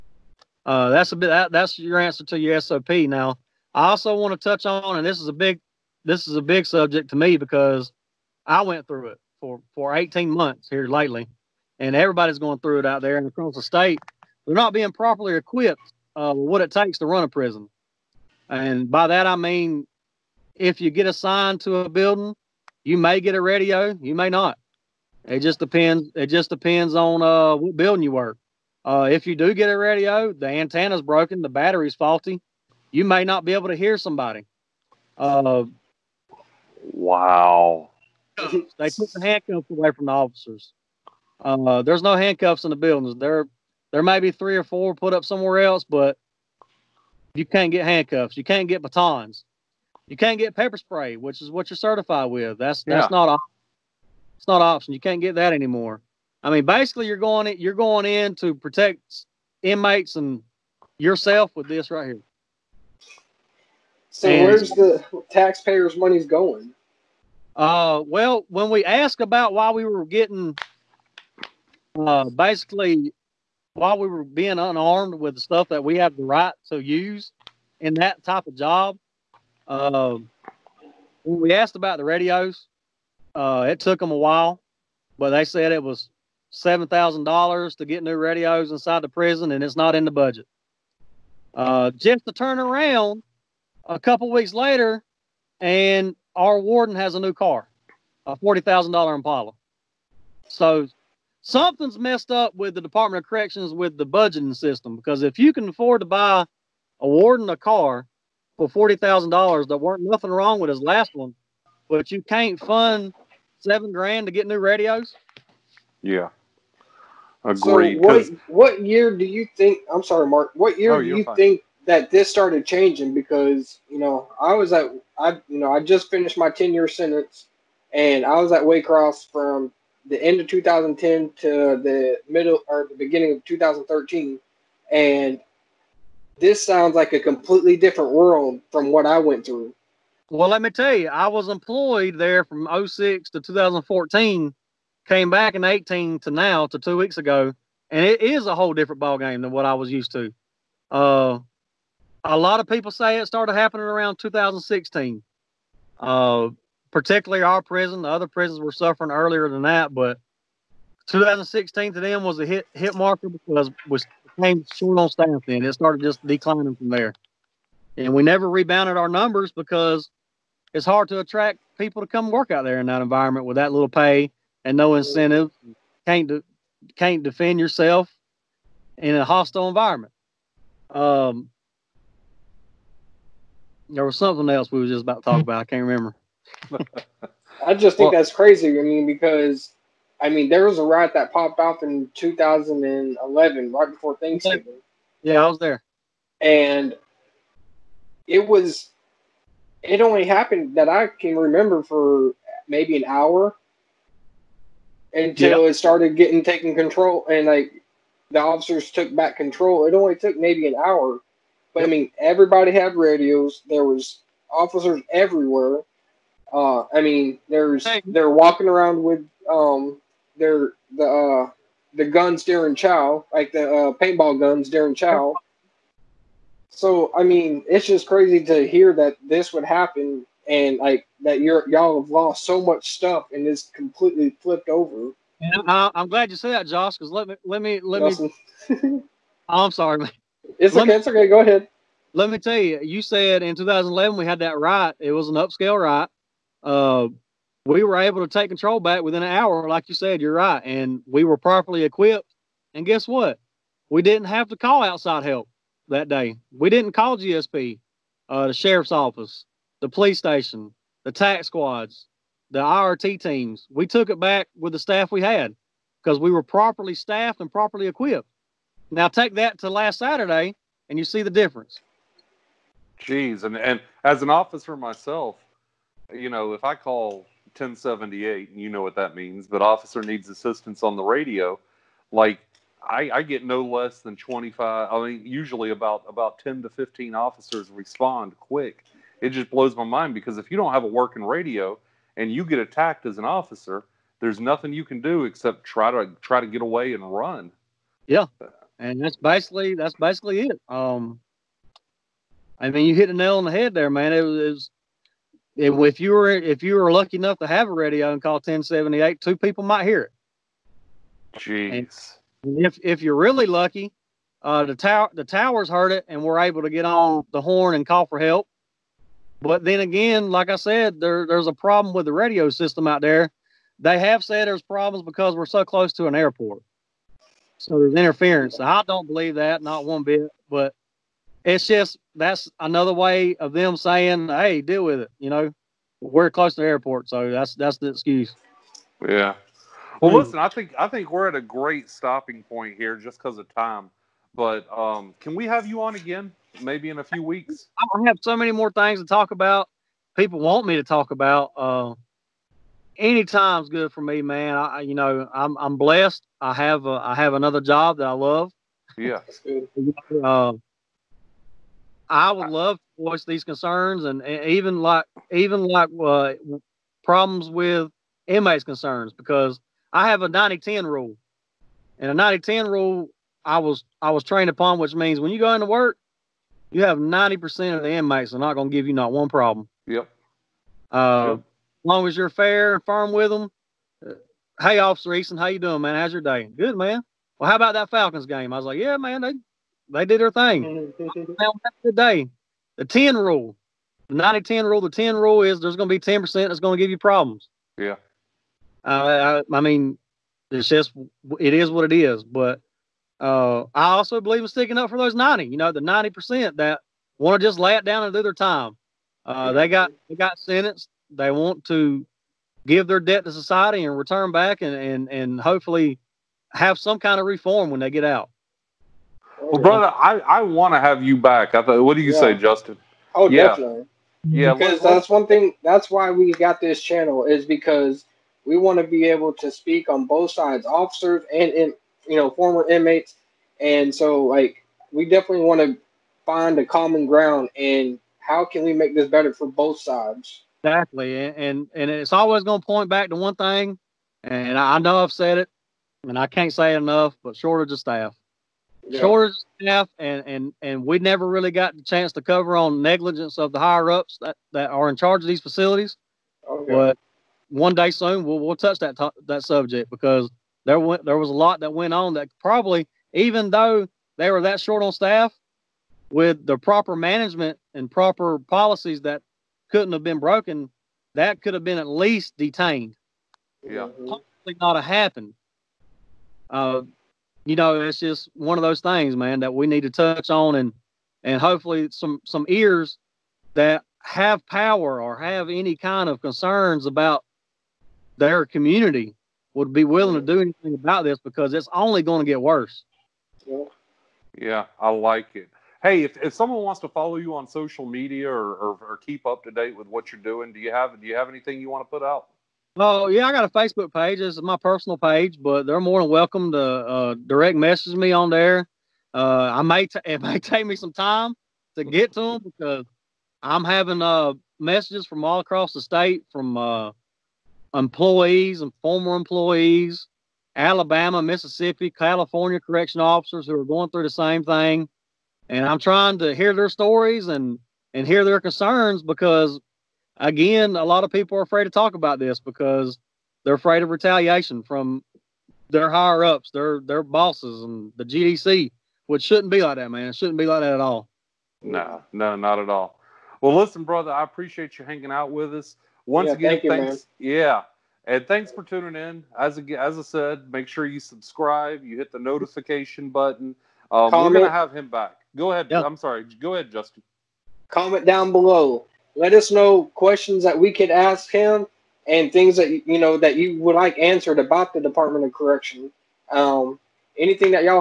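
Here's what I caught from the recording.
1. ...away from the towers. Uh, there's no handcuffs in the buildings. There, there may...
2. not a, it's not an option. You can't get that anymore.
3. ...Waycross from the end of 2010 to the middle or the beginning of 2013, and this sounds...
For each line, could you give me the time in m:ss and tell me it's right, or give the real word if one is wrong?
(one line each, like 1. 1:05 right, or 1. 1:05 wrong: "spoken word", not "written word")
1. 0:39 wrong: "officers", not "towers"
2. 0:53 right
3. 2:08 right.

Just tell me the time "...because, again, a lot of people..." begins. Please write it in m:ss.
8:49.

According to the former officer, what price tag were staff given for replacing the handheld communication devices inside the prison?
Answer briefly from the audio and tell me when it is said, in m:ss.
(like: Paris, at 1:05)
$7,000, at 1:26.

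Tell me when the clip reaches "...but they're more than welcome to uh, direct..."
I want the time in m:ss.
8:25.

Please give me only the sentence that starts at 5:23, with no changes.
They have said there's problems because we're so close to an airport.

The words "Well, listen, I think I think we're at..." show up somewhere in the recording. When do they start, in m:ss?
5:40.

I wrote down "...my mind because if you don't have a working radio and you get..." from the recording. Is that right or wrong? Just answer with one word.
right.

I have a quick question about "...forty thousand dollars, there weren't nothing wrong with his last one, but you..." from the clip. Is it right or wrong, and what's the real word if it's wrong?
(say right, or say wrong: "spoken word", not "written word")
right.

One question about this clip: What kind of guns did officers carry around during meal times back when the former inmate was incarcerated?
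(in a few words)
paintball guns.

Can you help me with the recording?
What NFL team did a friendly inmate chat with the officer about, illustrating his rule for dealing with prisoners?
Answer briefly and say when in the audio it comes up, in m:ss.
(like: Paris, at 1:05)
Falcons, at 6:27.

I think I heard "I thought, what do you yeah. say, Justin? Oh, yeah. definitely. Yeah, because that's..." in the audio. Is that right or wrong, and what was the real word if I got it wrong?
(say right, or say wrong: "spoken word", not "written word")
right.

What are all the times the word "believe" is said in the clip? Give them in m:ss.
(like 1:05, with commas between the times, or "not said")
5:29, 6:44.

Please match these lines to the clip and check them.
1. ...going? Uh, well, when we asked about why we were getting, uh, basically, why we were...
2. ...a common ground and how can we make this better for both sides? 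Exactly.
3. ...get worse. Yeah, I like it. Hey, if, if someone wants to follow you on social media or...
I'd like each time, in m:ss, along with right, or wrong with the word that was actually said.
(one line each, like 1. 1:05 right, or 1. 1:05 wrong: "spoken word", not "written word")
1. 1:06 right
2. 7:16 right
3. 8:12 right.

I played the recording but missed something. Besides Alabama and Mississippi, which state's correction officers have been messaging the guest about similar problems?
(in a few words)
California.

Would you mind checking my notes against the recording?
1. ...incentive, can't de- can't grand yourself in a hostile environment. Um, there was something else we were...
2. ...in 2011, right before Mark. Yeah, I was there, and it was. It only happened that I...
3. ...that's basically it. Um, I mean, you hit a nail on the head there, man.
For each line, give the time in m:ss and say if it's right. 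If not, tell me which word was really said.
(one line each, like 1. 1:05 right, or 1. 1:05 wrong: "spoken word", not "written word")
1. 2:54 wrong: "defend", not "grand"
2. 3:11 wrong: "Thanksgiving", not "Mark"
3. 4:59 right.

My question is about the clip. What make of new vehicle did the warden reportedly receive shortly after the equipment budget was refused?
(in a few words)
Impala.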